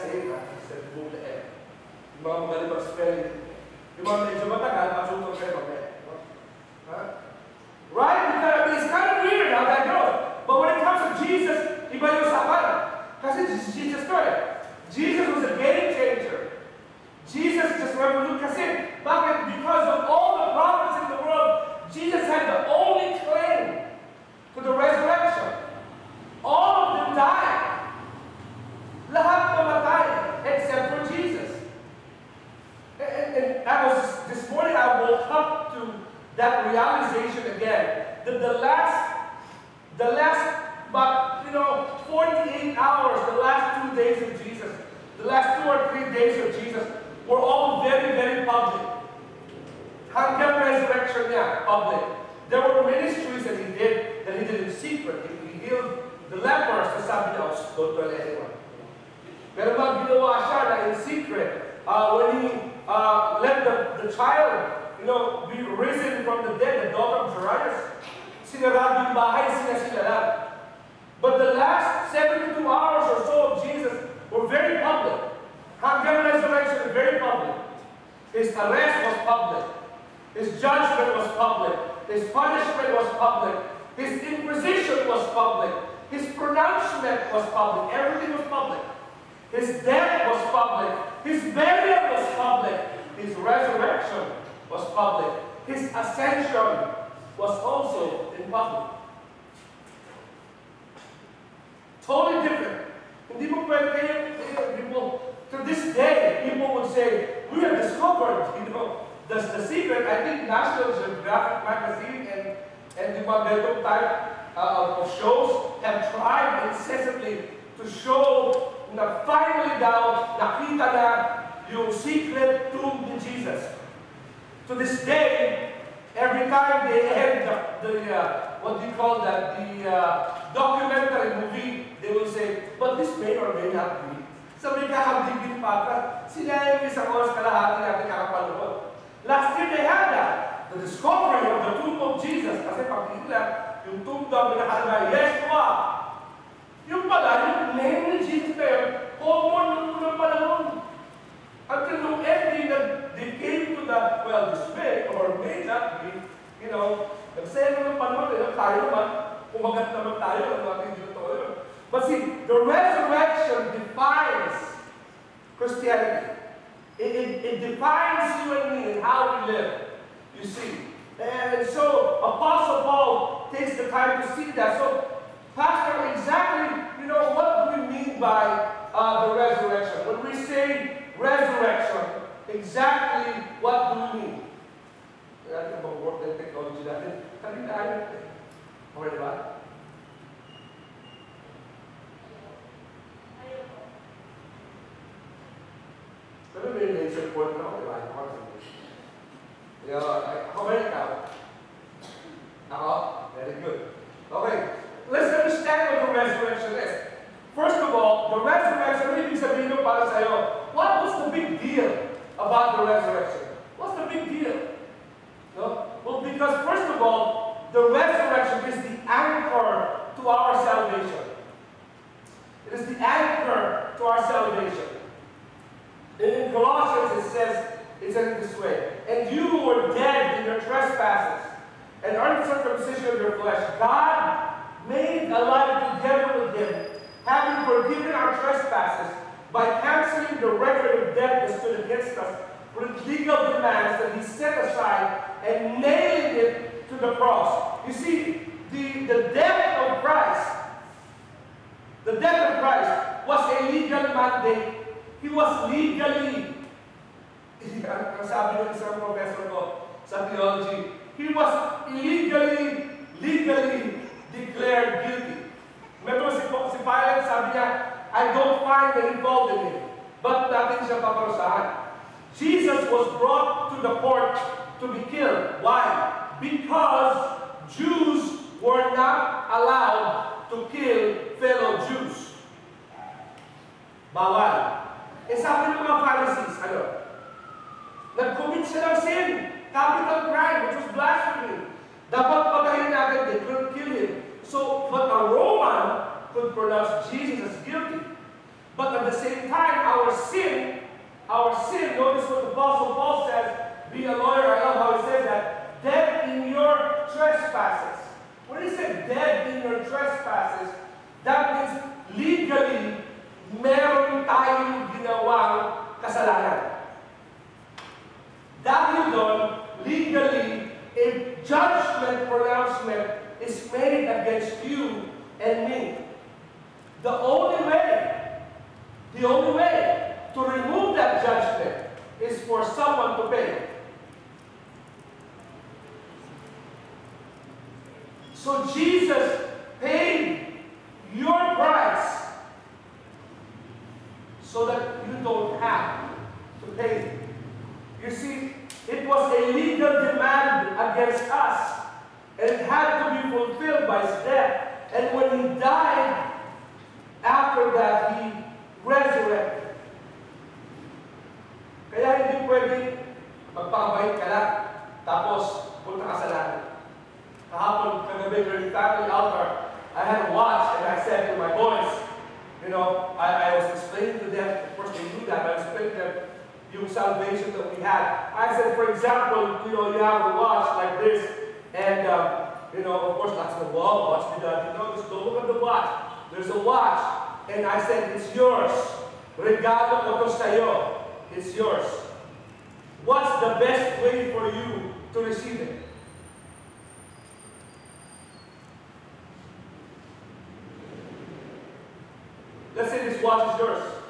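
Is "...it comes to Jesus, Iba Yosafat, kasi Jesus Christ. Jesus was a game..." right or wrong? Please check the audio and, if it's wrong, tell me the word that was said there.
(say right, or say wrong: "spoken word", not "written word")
right.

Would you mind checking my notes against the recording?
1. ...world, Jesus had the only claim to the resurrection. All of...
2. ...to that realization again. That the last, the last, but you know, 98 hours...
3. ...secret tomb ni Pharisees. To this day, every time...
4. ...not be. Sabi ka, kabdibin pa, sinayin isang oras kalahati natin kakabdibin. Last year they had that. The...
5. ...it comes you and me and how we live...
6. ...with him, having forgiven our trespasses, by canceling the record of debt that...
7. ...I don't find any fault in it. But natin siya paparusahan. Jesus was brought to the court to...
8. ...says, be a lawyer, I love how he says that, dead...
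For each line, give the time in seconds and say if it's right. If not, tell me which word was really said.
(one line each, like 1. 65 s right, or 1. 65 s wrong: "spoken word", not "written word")
1. 21 s right
2. 35 s wrong: "48", not "98"
3. 121 s wrong: "Jesus", not "Pharisees"
4. 133 s right
5. 167 s wrong: "defines", not "comes"
6. 236 s right
7. 268 s right
8. 303 s right.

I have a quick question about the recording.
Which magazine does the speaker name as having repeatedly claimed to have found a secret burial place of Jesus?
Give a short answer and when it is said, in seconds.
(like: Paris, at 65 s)
National Geographic, at 110 s.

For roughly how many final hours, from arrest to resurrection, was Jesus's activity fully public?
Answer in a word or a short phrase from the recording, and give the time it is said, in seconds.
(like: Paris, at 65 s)
72 hours, at 72 s.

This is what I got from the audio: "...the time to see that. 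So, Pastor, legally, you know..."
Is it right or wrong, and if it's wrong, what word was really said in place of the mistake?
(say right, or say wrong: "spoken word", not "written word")
wrong: "exactly", not "legally".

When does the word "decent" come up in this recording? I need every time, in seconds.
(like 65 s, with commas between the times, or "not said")
not said.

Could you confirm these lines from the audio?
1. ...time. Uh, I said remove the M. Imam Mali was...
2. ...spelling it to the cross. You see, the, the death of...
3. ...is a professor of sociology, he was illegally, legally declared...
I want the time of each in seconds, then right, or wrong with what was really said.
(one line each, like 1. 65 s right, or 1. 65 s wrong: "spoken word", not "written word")
1. 0 s right
2. 245 s wrong: "nailing", not "spelling"
3. 258 s right.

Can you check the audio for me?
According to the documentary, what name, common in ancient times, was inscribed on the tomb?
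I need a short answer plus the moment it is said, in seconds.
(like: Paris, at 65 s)
Yeshua, at 145 s.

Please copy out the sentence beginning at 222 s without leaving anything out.
It is the anchor to our salvation.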